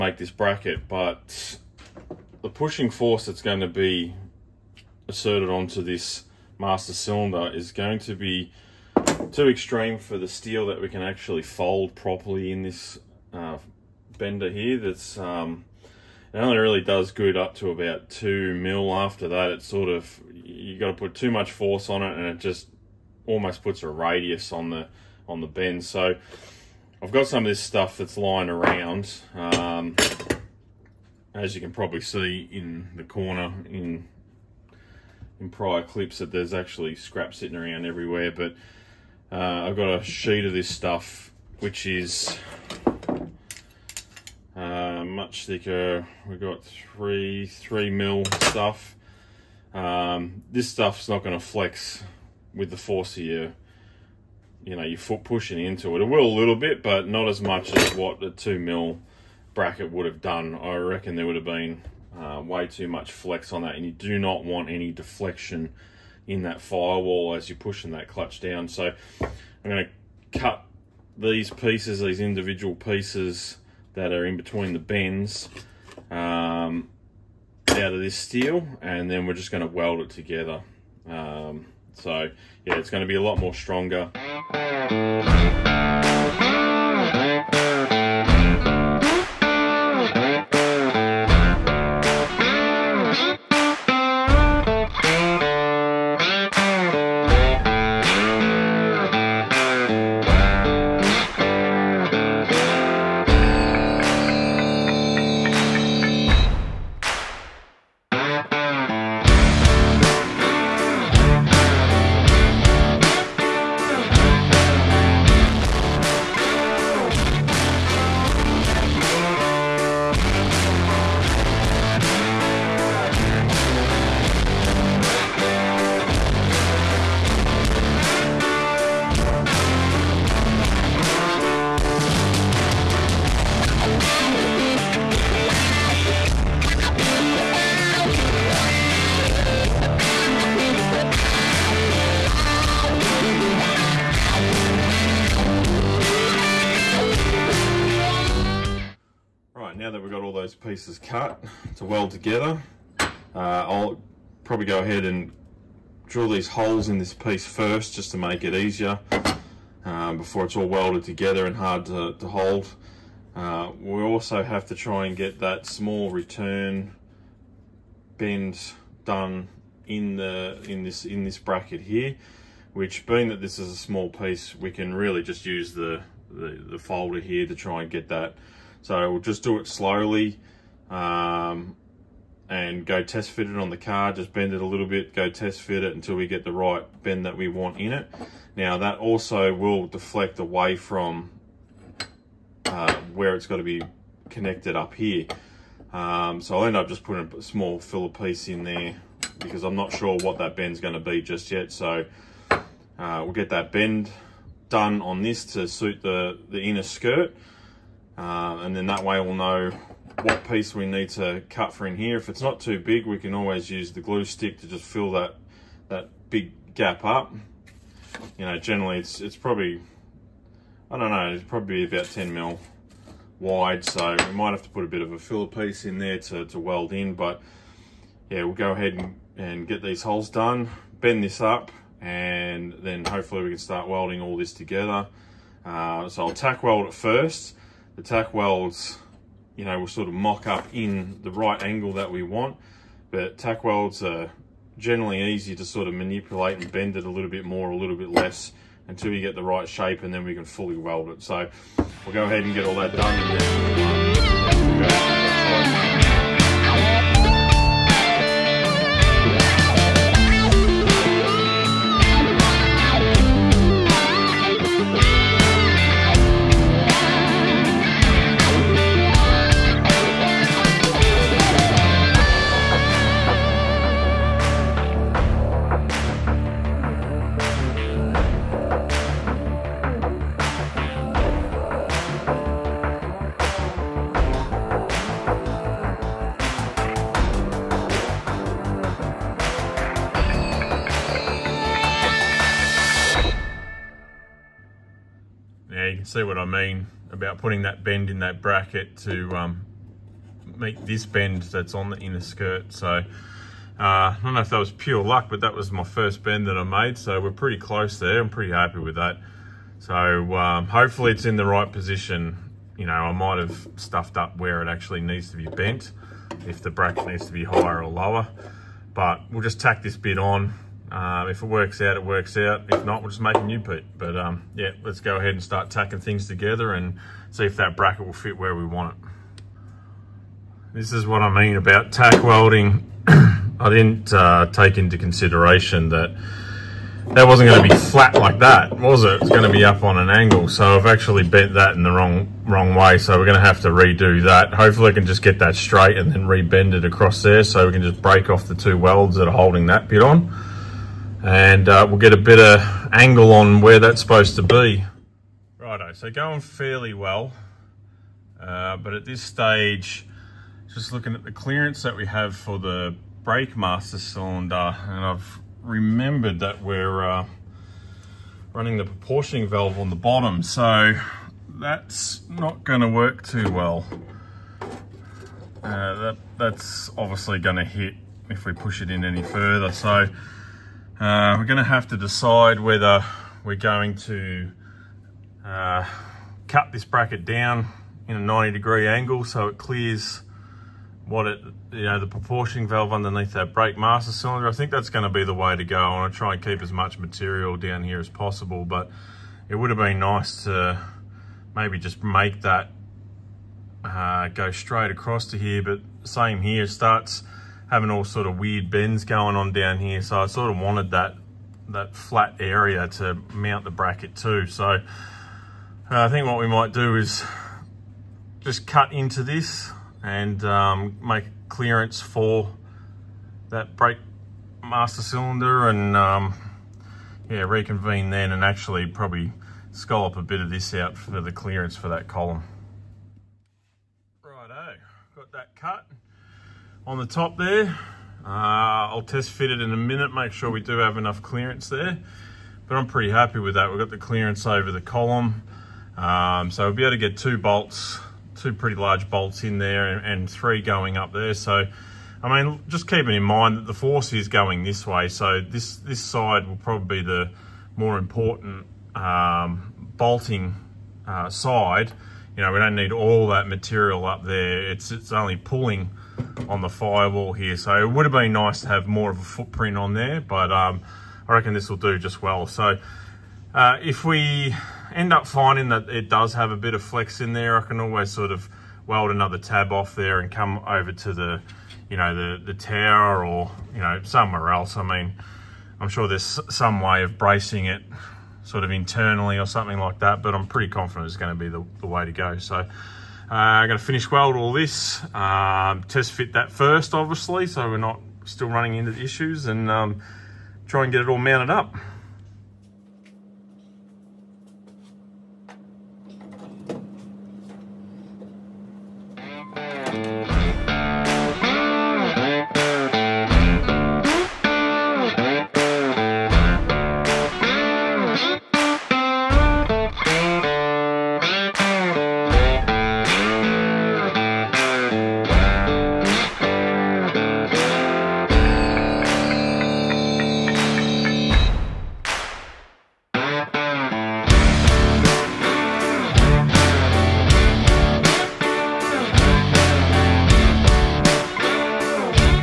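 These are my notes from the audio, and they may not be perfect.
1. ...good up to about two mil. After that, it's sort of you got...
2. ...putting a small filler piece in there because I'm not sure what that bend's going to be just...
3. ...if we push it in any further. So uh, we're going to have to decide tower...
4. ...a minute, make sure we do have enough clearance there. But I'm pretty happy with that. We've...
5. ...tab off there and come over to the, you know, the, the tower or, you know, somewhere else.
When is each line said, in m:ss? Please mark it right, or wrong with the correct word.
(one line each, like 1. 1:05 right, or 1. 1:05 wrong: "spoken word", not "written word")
1. 0:17 right
2. 3:17 right
3. 6:18 wrong: "whether", not "tower"
4. 7:19 right
5. 7:59 right.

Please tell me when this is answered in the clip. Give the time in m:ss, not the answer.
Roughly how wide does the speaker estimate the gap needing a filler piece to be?
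3:42.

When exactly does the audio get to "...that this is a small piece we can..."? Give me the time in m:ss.
2:53.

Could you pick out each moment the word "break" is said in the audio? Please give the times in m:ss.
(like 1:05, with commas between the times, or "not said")
5:48.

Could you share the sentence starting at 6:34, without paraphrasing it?
I think that's going to be the way to go.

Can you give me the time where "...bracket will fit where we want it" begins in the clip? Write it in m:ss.
5:27.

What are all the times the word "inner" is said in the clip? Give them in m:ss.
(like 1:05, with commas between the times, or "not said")
3:26, 5:01.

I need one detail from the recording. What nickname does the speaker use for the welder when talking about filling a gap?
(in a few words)
glue stick.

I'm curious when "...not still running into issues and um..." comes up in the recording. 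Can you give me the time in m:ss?
8:17.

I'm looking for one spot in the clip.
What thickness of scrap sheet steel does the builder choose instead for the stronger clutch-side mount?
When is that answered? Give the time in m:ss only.
0:47.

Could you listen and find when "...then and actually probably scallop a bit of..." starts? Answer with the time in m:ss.
7:08.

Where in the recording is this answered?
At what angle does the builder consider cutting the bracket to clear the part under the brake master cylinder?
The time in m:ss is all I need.
6:28.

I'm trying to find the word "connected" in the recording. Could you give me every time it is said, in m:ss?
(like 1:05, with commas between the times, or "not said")
3:14.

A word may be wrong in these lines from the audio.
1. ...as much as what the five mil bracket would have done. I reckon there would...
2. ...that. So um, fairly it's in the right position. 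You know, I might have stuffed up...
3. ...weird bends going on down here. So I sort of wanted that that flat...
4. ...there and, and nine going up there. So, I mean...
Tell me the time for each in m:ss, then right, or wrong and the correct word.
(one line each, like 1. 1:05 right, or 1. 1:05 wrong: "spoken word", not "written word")
1. 0:57 wrong: "two", not "five"
2. 5:08 wrong: "hopefully", not "fairly"
3. 6:48 right
4. 7:29 wrong: "three", not "nine".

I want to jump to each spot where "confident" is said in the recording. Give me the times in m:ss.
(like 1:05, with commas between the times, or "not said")
8:10.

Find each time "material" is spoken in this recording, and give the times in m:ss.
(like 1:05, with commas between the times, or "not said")
6:36, 7:43.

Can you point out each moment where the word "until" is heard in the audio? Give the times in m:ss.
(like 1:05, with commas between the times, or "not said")
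3:05, 4:08.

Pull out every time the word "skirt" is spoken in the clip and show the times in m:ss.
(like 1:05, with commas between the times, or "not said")
3:26, 5:02.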